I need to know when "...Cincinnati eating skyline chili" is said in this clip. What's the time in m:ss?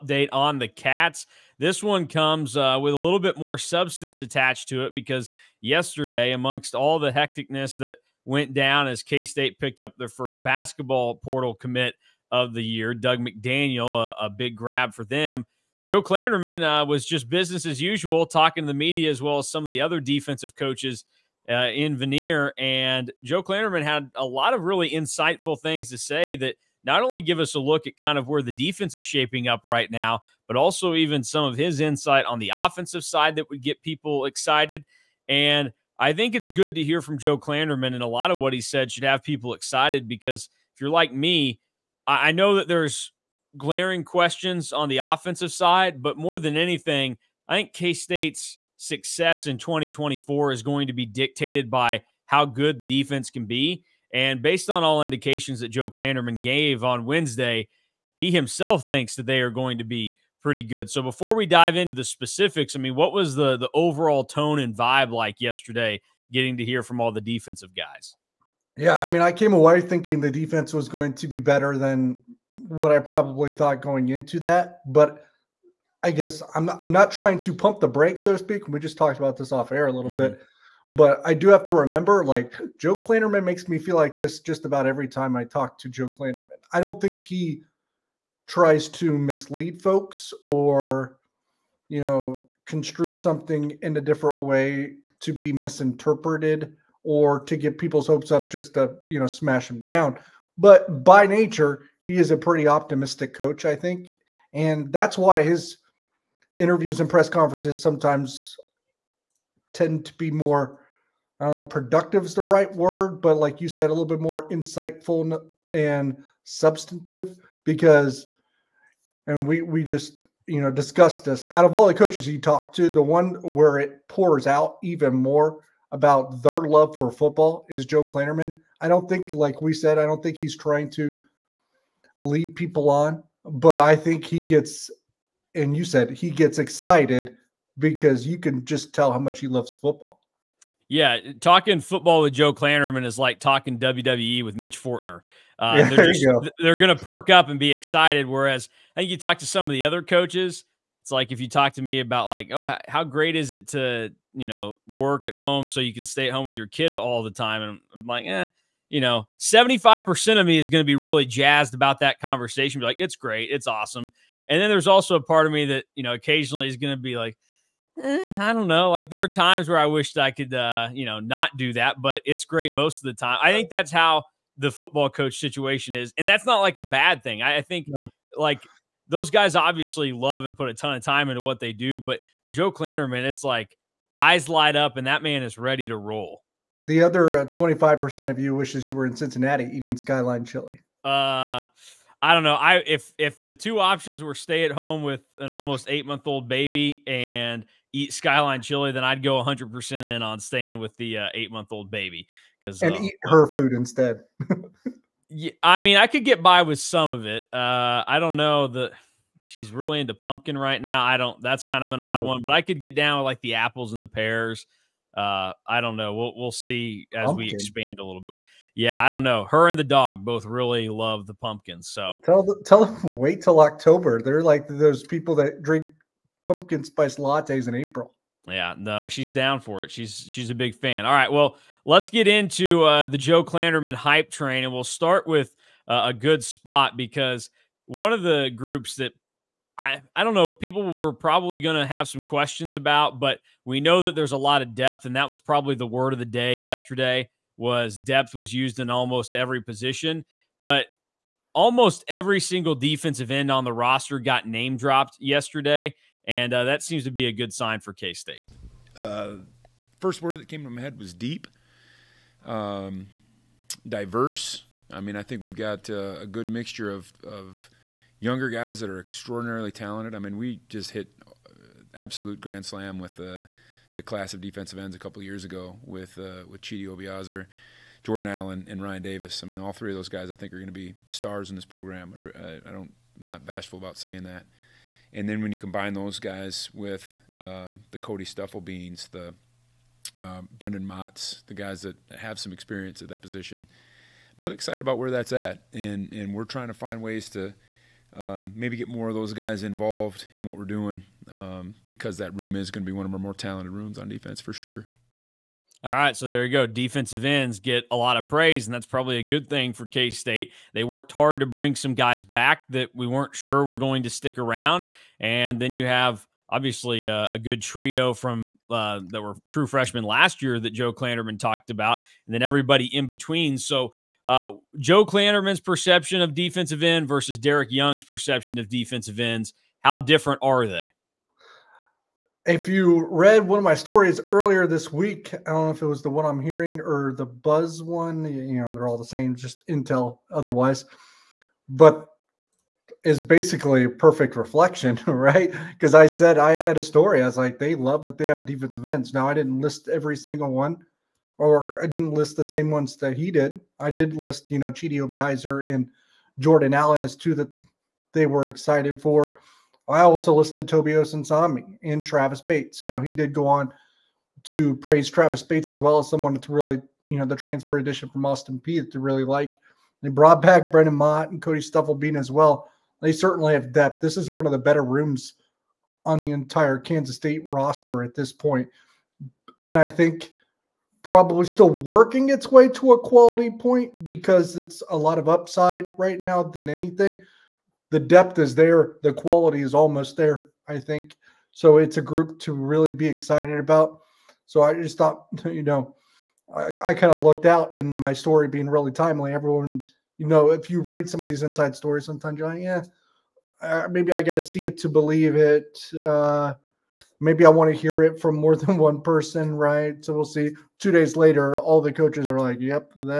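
3:09.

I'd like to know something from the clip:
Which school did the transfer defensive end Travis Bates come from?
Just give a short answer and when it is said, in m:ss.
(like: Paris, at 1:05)
Austin Peay, at 6:08.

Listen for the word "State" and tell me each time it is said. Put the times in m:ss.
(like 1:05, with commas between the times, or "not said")
0:09, 0:47, 4:18, 5:10, 6:17.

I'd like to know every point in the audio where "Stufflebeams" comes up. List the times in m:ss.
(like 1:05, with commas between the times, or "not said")
4:48, 6:11.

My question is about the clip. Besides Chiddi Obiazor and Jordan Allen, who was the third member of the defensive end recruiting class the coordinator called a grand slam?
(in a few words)
Ryan Davis.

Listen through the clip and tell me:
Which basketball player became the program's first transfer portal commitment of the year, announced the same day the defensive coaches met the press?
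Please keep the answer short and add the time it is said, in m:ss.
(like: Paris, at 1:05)
Dug McDaniel, at 0:12.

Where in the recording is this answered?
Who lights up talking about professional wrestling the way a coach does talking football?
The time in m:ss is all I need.
2:24.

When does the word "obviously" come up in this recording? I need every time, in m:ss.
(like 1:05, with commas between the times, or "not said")
2:59, 5:16.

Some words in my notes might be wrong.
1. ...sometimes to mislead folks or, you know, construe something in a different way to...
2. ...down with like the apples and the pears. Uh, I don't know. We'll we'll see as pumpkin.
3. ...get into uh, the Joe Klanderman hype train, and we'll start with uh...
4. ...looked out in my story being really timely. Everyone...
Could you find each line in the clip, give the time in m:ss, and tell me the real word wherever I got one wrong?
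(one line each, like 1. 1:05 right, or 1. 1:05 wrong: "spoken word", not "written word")
1. 1:28 wrong: "tries", not "sometimes"
2. 3:32 right
3. 3:52 right
4. 6:37 right.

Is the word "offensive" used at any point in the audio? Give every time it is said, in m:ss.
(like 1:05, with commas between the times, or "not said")
0:32, 0:44.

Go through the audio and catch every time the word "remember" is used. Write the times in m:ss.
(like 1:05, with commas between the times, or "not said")
1:21.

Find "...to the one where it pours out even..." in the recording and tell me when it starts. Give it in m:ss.
2:02.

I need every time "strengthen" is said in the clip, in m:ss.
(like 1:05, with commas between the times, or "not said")
not said.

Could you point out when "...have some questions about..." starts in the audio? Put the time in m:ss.
4:01.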